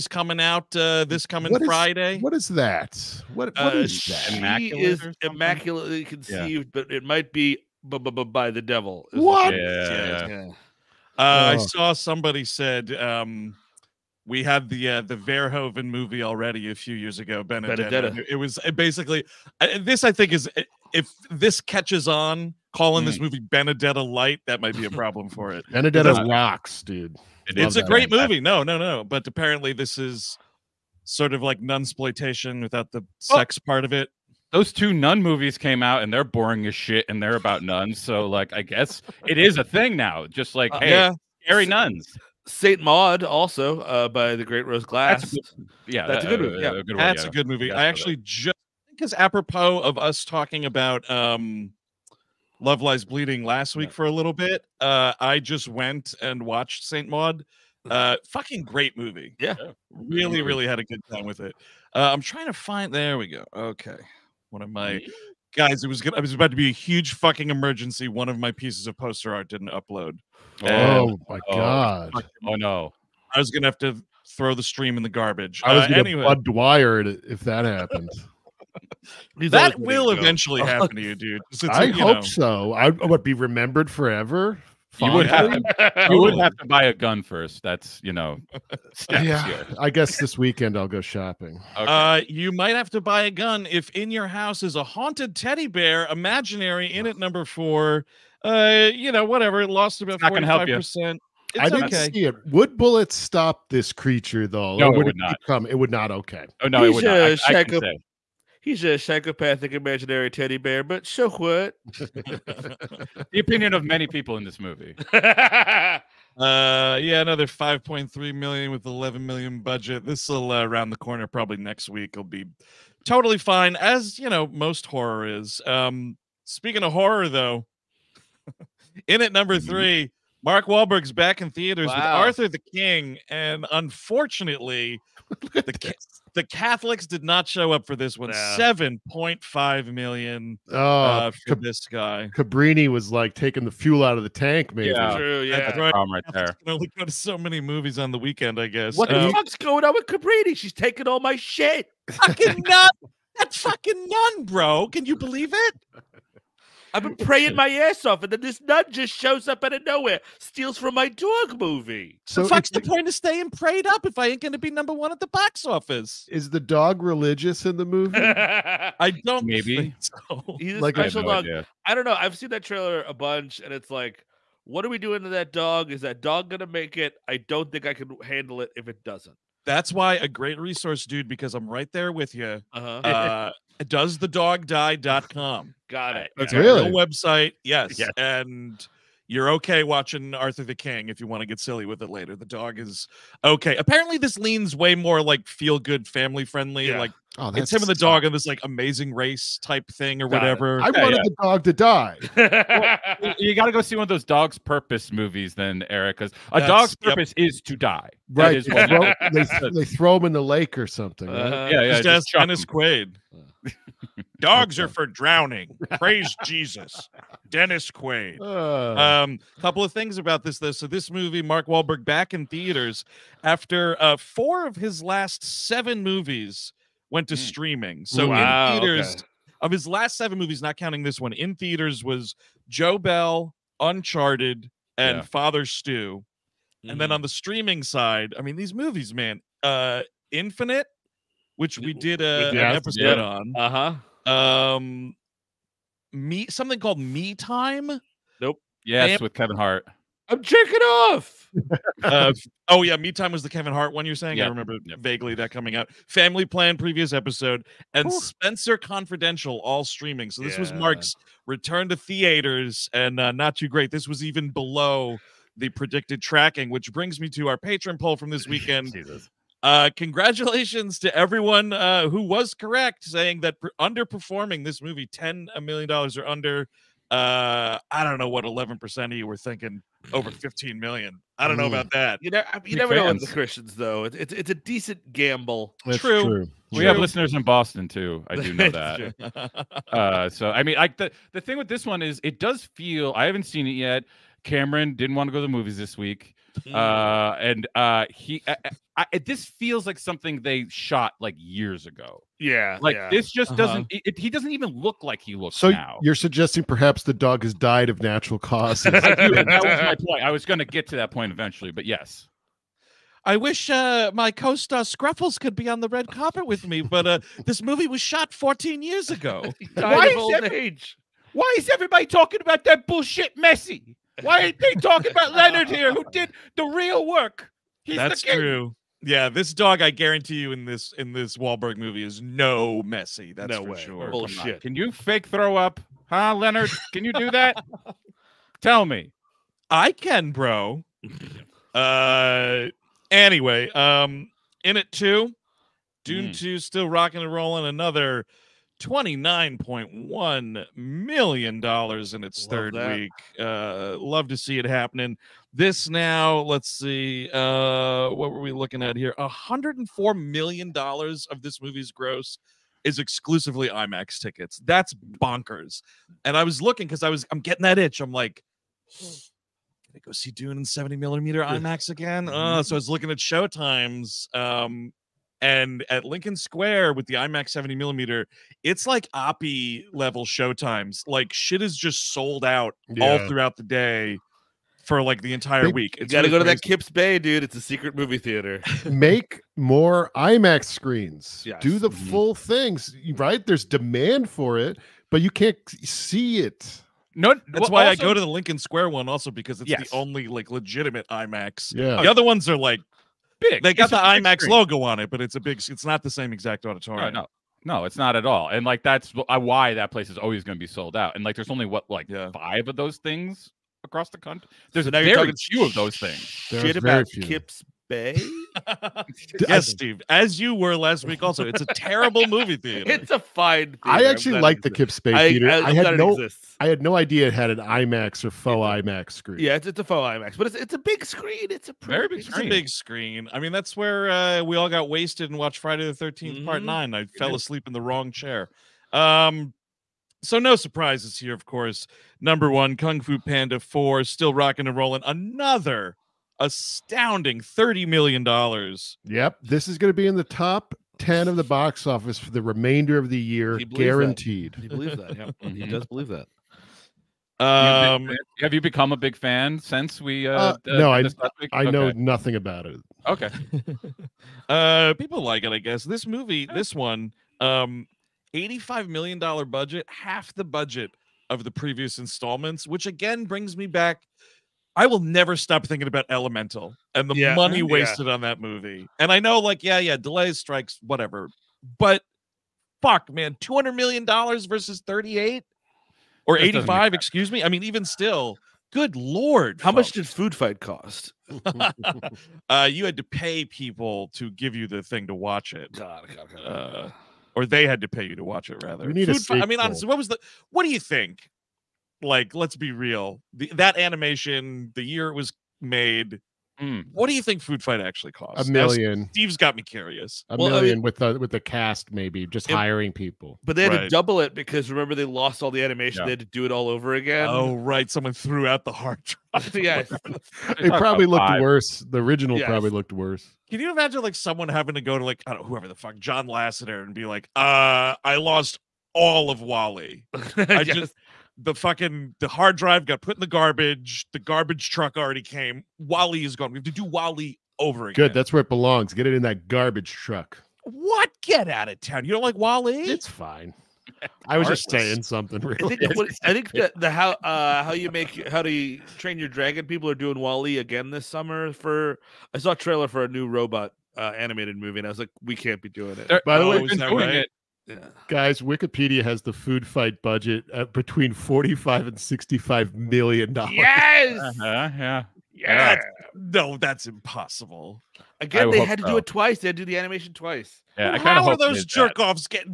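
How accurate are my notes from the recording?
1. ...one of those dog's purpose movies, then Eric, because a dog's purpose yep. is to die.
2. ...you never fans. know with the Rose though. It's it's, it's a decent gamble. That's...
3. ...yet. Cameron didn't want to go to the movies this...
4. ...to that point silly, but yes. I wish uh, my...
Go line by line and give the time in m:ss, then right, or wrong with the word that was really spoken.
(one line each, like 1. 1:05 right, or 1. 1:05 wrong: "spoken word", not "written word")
1. 3:23 right
2. 4:42 wrong: "Christians", not "Rose"
3. 4:53 right
4. 5:10 wrong: "eventually", not "silly".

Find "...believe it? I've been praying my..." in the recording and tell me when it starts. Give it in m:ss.
2:35.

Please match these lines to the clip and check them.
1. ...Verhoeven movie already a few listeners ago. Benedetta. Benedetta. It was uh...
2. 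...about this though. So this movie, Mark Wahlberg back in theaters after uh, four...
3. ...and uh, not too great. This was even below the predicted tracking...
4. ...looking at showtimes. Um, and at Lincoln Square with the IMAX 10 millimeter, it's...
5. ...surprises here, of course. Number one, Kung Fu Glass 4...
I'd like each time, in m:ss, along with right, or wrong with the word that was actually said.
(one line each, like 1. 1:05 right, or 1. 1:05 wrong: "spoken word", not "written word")
1. 0:15 wrong: "years", not "listeners"
2. 3:40 right
3. 4:22 right
4. 6:12 wrong: "70", not "10"
5. 7:20 wrong: "Panda", not "Glass".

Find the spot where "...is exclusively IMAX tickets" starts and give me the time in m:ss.
6:02.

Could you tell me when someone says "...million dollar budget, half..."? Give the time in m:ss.
7:48.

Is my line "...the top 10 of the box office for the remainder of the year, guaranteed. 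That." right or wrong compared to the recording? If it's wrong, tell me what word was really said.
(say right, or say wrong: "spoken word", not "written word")
right.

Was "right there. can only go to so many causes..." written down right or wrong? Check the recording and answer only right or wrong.
wrong.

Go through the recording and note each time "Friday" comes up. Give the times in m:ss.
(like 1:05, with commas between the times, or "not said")
0:01, 7:15.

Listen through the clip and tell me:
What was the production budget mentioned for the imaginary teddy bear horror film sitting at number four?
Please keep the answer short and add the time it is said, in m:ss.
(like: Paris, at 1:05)
$11 million, at 1:58.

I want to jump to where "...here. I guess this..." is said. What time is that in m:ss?
1:29.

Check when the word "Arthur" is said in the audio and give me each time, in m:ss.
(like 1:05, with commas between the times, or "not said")
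2:12, 3:10.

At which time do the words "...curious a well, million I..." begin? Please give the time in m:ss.
8:29.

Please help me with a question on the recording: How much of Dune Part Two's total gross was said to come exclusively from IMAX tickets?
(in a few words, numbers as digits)
$104 million.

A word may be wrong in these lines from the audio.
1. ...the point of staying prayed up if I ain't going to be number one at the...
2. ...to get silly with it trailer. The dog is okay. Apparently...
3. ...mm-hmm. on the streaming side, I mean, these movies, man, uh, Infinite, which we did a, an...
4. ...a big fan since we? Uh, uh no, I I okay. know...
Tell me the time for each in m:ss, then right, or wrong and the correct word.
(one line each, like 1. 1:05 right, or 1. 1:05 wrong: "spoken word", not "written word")
1. 2:42 right
2. 3:11 wrong: "later", not "trailer"
3. 3:57 right
4. 7:38 right.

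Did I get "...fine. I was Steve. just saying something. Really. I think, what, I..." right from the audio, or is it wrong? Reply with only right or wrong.
wrong.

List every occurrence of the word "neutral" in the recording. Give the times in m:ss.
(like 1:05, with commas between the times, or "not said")
not said.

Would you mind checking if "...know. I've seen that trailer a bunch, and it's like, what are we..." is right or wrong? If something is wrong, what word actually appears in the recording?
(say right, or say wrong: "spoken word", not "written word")
right.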